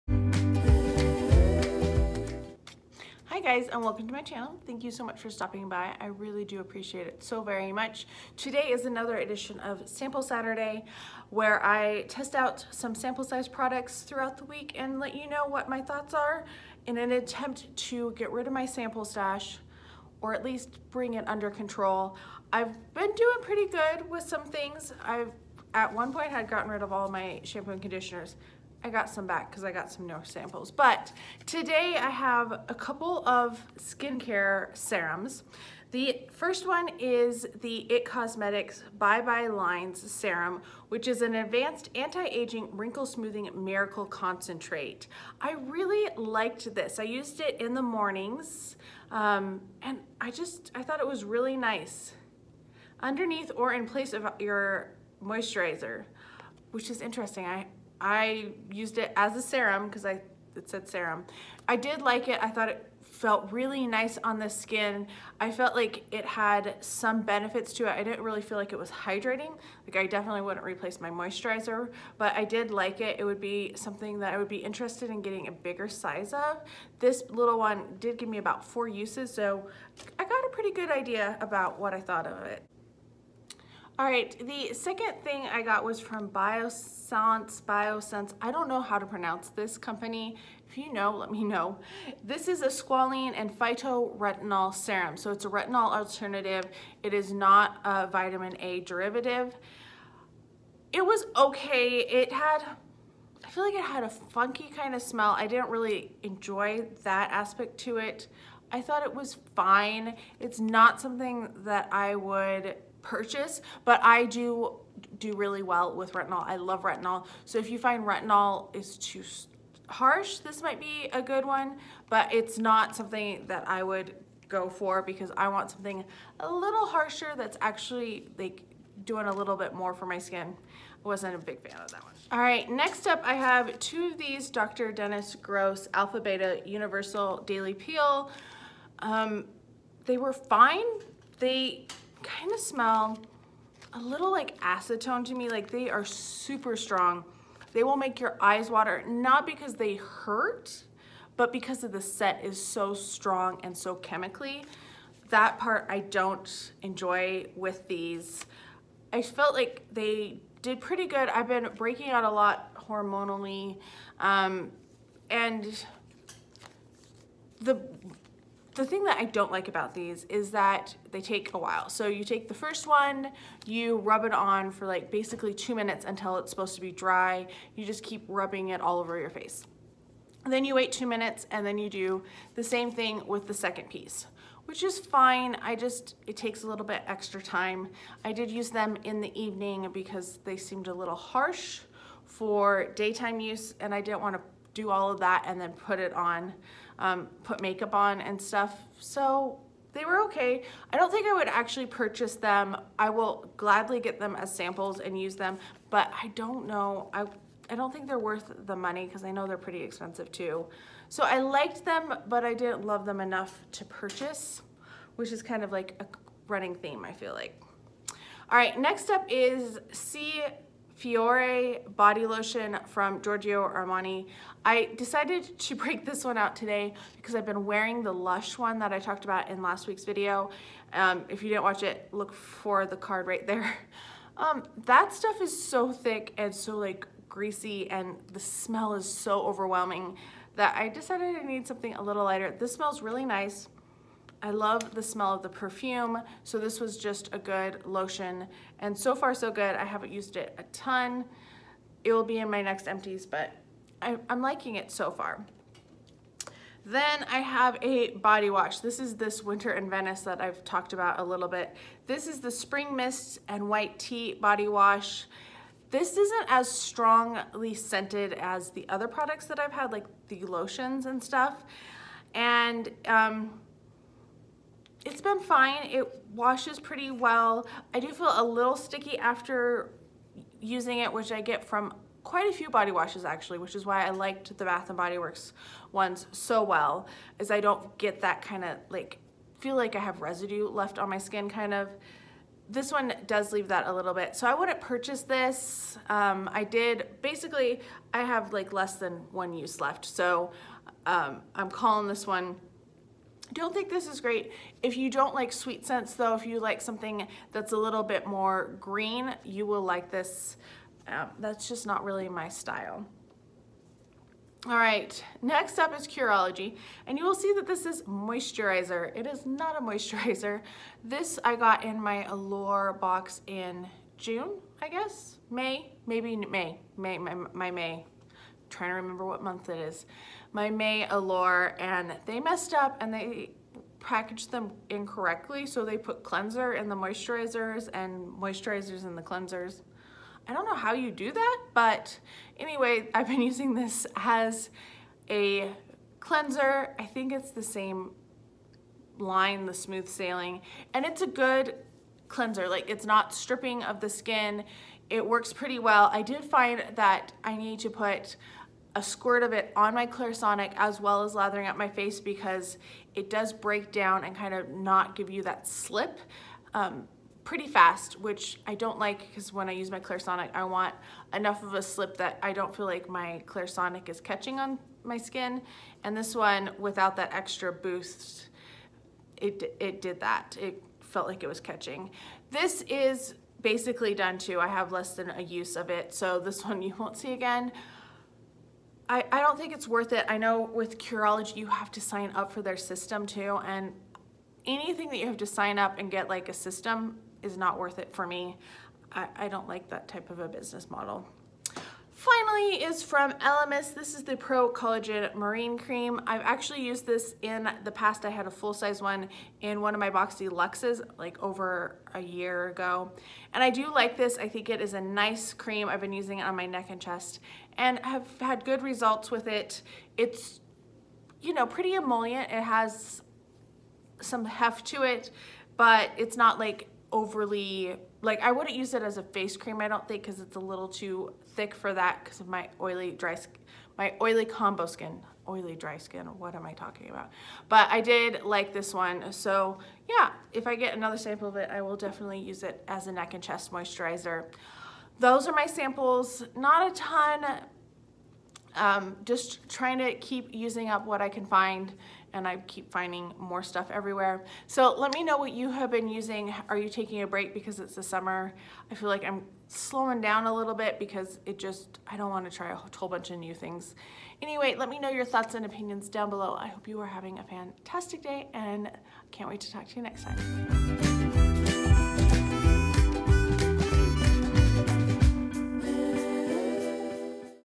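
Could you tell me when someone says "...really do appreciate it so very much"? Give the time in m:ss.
0:06.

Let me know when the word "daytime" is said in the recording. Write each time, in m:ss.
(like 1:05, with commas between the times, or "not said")
3:12.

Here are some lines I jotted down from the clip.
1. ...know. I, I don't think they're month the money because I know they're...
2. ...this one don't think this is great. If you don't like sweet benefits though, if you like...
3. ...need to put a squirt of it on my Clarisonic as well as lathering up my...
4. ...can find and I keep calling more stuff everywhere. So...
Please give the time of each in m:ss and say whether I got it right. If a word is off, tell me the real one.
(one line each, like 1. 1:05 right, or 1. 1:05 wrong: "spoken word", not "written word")
1. 3:26 wrong: "worth", not "month"
2. 5:02 wrong: "scents", not "benefits"
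3. 5:57 right
4. 7:31 wrong: "finding", not "calling".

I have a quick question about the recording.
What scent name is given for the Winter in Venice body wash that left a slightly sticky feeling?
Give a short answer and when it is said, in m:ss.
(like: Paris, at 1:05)
Spring Mist and White Tea, at 4:22.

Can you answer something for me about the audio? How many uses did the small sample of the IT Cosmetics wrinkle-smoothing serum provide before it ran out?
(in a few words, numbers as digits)
4.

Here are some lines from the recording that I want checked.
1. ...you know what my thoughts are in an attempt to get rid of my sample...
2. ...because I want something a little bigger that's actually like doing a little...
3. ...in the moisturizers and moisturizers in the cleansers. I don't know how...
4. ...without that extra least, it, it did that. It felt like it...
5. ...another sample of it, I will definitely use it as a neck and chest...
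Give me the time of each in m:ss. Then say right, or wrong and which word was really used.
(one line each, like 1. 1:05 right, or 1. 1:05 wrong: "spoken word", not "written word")
1. 0:15 right
2. 2:05 wrong: "harsher", not "bigger"
3. 5:36 right
4. 6:16 wrong: "boost", not "least"
5. 7:20 right.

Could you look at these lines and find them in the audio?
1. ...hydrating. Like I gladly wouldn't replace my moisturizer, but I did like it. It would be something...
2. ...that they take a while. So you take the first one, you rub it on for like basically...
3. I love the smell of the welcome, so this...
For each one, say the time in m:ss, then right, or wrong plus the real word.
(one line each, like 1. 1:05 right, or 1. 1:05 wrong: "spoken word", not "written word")
1. 1:08 wrong: "definitely", not "gladly"
2. 2:50 right
3. 4:04 wrong: "perfume", not "welcome".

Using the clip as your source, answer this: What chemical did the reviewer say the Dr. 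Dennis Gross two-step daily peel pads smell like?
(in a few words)
acetone.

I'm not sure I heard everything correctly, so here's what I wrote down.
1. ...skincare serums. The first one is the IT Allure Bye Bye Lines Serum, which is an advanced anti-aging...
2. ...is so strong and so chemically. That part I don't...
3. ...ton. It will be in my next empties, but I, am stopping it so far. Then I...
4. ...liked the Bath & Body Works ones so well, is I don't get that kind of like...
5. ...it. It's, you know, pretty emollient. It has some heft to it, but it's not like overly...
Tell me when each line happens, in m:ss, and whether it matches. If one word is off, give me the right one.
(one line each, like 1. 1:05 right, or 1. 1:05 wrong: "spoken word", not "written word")
1. 0:33 wrong: "Cosmetics", not "Allure"
2. 2:32 right
3. 4:10 wrong: "liking", not "stopping"
4. 4:44 right
5. 6:59 right.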